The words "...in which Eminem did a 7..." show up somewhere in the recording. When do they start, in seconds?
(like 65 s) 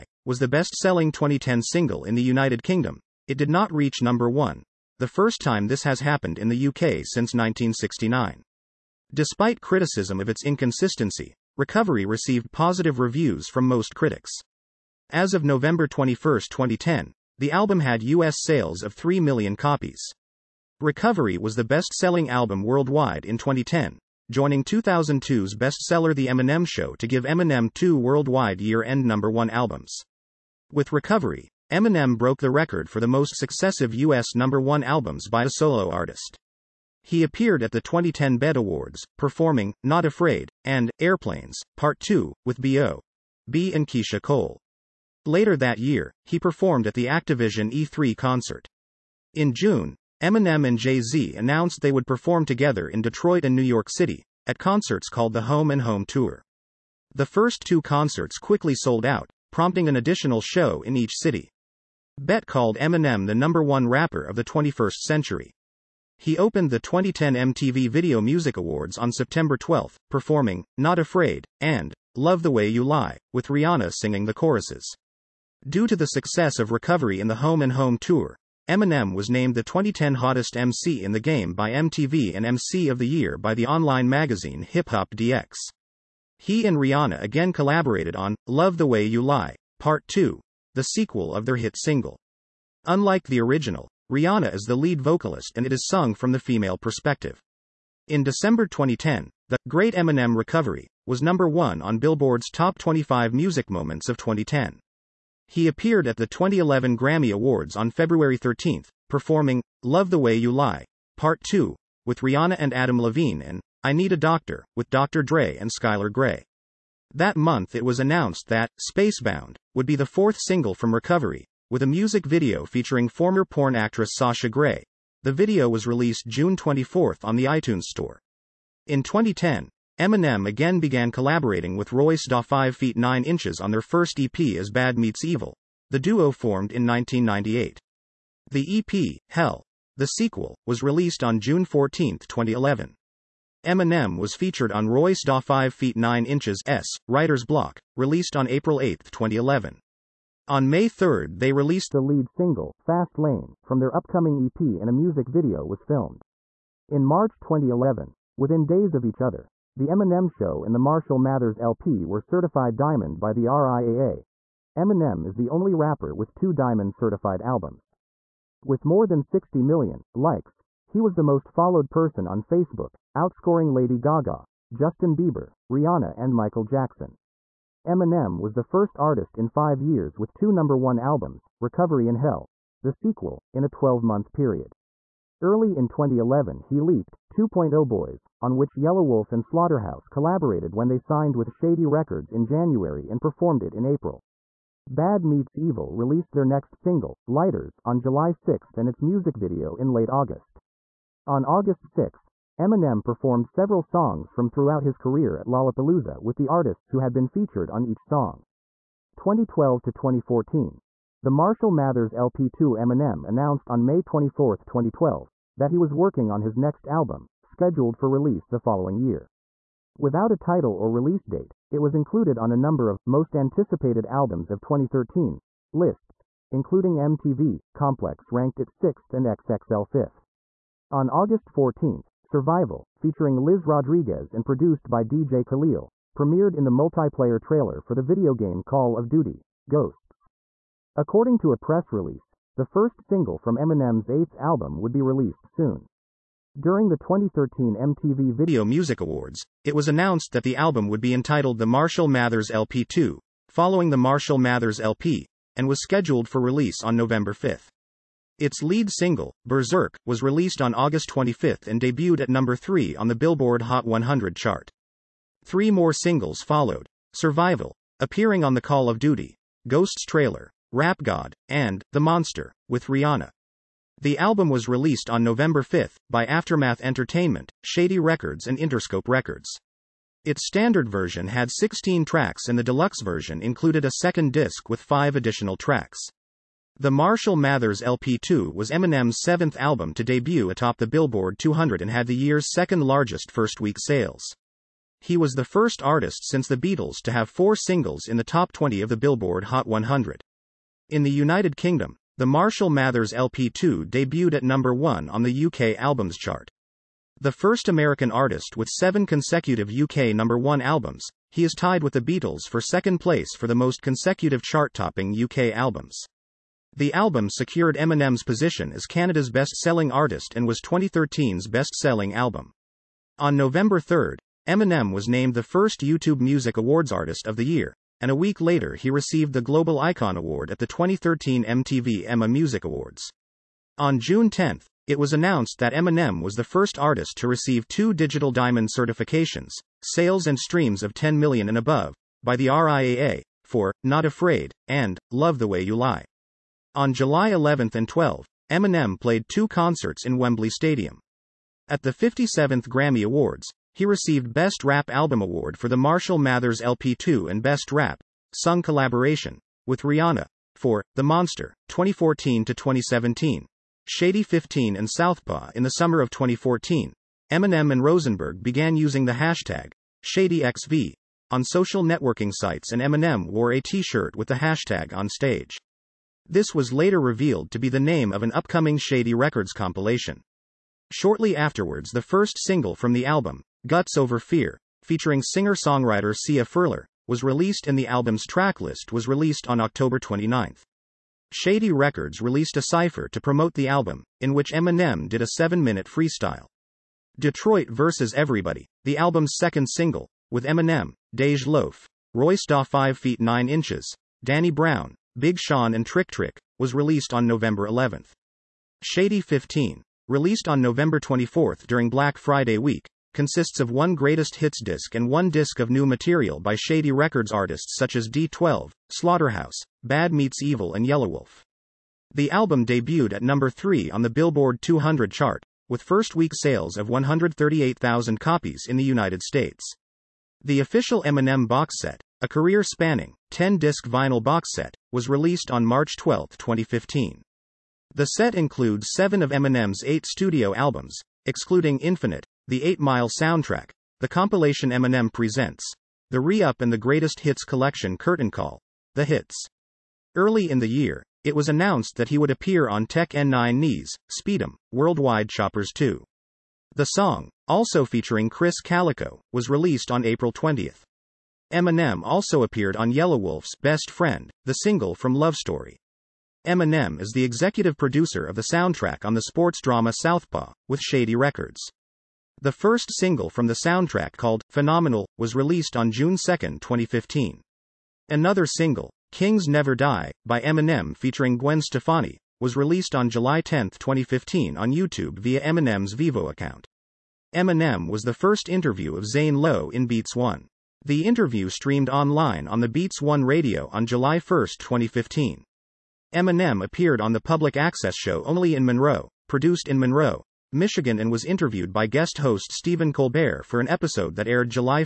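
394 s.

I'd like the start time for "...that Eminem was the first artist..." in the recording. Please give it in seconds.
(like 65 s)
335 s.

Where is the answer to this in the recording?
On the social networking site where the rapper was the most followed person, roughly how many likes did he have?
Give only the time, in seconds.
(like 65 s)
169 s.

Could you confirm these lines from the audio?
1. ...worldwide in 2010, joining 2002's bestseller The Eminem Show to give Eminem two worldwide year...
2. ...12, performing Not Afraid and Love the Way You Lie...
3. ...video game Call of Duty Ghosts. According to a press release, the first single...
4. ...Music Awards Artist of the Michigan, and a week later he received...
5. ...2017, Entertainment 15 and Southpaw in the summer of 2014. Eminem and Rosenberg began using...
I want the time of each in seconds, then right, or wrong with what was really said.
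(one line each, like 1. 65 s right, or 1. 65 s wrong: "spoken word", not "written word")
1. 22 s right
2. 69 s right
3. 238 s right
4. 326 s wrong: "Year", not "Michigan"
5. 362 s wrong: "Shady", not "Entertainment".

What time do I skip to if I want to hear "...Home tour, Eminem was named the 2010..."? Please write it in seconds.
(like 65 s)
77 s.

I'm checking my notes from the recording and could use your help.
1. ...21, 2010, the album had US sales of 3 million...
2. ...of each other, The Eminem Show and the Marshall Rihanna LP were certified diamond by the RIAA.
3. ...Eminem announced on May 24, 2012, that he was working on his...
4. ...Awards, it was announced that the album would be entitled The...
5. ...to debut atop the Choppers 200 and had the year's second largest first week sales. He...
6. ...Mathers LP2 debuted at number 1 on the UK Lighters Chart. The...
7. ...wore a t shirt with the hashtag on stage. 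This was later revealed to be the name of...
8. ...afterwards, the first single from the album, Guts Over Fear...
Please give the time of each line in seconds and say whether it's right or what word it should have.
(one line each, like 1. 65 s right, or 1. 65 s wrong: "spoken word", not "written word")
1. 15 s right
2. 158 s wrong: "Mathers", not "Rihanna"
3. 212 s right
4. 248 s right
5. 289 s wrong: "Billboard", not "Choppers"
6. 302 s wrong: "Albums", not "Lighters"
7. 373 s right
8. 381 s right.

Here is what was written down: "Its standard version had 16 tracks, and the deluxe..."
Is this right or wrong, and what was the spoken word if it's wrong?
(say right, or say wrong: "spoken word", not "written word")
right.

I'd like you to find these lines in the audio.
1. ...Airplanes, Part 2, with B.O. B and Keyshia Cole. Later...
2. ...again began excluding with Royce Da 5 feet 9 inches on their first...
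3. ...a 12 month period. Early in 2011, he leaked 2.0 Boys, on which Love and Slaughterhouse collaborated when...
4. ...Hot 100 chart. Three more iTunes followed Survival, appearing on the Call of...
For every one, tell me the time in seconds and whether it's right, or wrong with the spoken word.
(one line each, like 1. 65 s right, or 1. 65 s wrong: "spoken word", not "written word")
1. 40 s right
2. 130 s wrong: "collaborating", not "excluding"
3. 183 s wrong: "Yelawolf", not "Love"
4. 263 s wrong: "singles", not "iTunes".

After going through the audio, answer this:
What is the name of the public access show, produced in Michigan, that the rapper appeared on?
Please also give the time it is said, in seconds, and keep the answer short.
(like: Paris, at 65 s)
Only in Monroe, at 498 s.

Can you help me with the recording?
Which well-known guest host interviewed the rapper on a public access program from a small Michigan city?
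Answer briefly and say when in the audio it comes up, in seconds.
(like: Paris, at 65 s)
Stephen Colbert, at 502 s.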